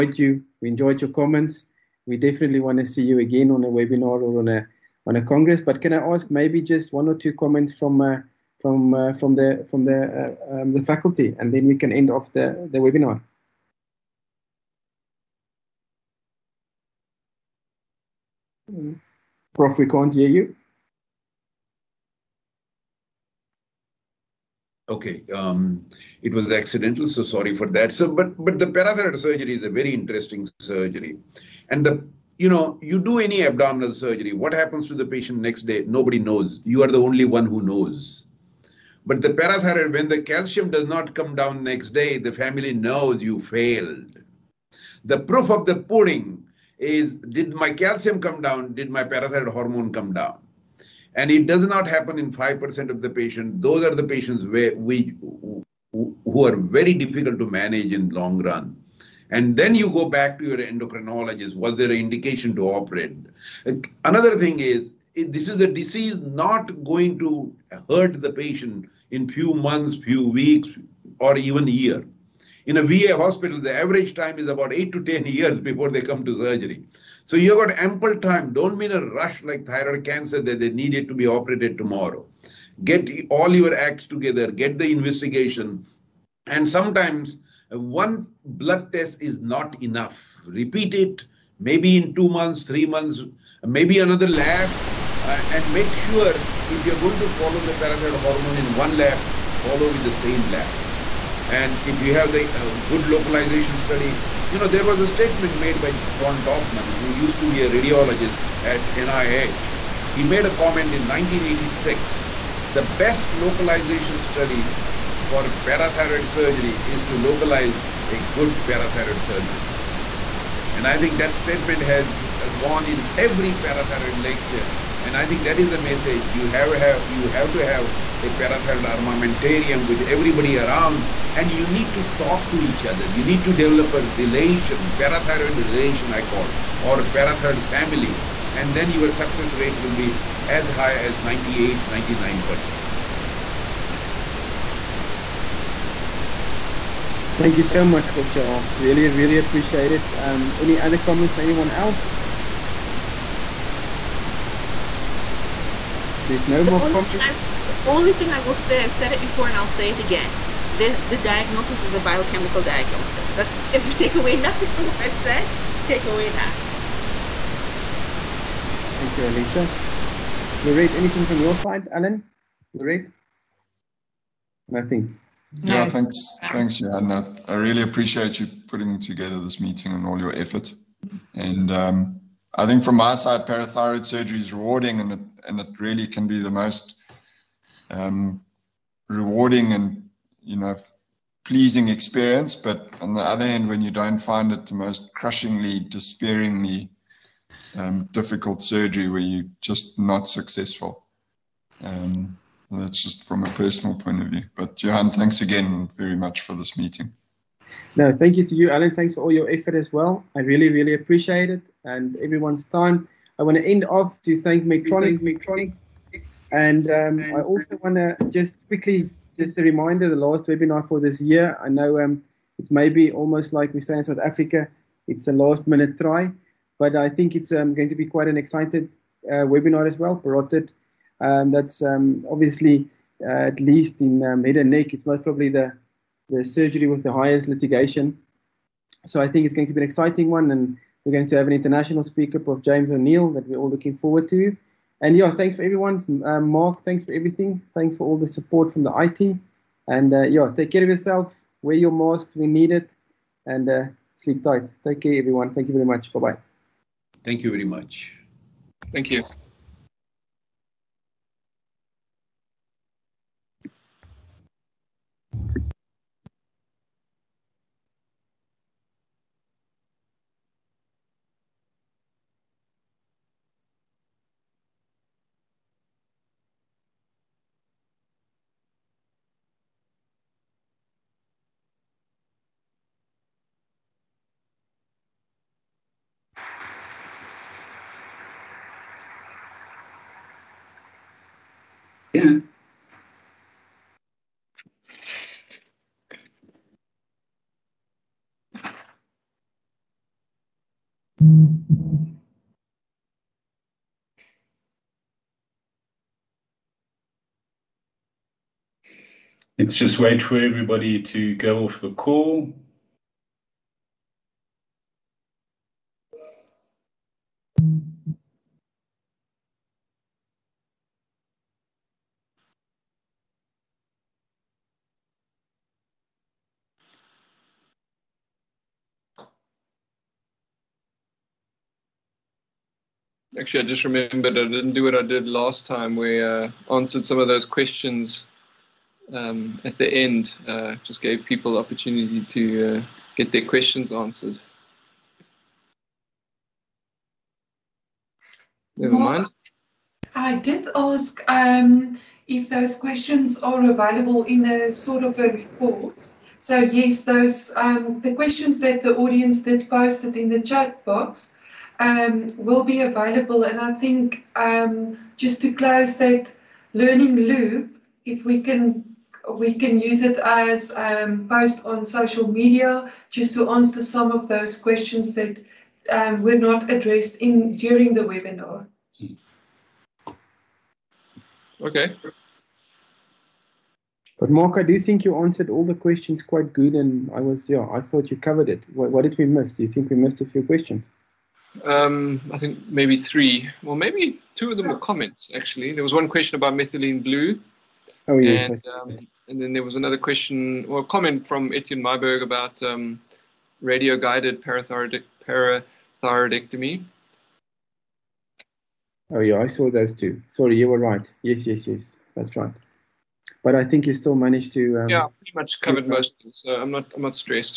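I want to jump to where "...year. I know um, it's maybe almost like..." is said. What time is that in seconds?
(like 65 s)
221 s.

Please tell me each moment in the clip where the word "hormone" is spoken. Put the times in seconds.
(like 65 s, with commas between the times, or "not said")
49 s, 98 s.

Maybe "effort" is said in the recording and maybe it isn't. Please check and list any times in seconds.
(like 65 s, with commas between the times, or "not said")
180 s, 209 s.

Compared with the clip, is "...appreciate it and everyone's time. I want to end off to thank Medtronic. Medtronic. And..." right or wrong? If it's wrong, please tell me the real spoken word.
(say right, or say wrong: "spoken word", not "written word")
right.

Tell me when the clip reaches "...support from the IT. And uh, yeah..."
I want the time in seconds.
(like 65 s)
248 s.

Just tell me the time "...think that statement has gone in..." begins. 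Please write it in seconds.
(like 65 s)
120 s.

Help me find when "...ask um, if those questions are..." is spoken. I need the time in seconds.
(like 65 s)
350 s.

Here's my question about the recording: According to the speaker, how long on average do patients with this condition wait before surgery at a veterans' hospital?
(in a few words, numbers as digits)
8 to 10 years.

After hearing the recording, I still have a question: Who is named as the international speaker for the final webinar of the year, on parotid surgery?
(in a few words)
James O'Neill.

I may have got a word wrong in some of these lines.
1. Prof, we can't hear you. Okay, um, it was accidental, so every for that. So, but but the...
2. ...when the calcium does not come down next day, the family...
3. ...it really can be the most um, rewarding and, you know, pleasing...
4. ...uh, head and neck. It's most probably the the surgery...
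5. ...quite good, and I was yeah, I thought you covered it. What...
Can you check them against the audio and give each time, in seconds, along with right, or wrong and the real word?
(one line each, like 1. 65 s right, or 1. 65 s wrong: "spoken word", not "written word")
1. 19 s wrong: "sorry", not "every"
2. 39 s right
3. 185 s right
4. 234 s right
5. 386 s right.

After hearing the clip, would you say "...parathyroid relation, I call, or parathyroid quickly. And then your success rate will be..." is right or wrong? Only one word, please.
wrong.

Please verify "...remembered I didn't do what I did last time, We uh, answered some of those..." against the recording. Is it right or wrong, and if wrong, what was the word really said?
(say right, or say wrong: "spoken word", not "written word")
right.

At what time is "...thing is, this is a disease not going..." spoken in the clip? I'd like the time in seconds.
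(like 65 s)
64 s.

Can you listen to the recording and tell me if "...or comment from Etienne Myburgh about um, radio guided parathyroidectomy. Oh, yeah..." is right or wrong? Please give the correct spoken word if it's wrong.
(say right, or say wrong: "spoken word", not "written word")
right.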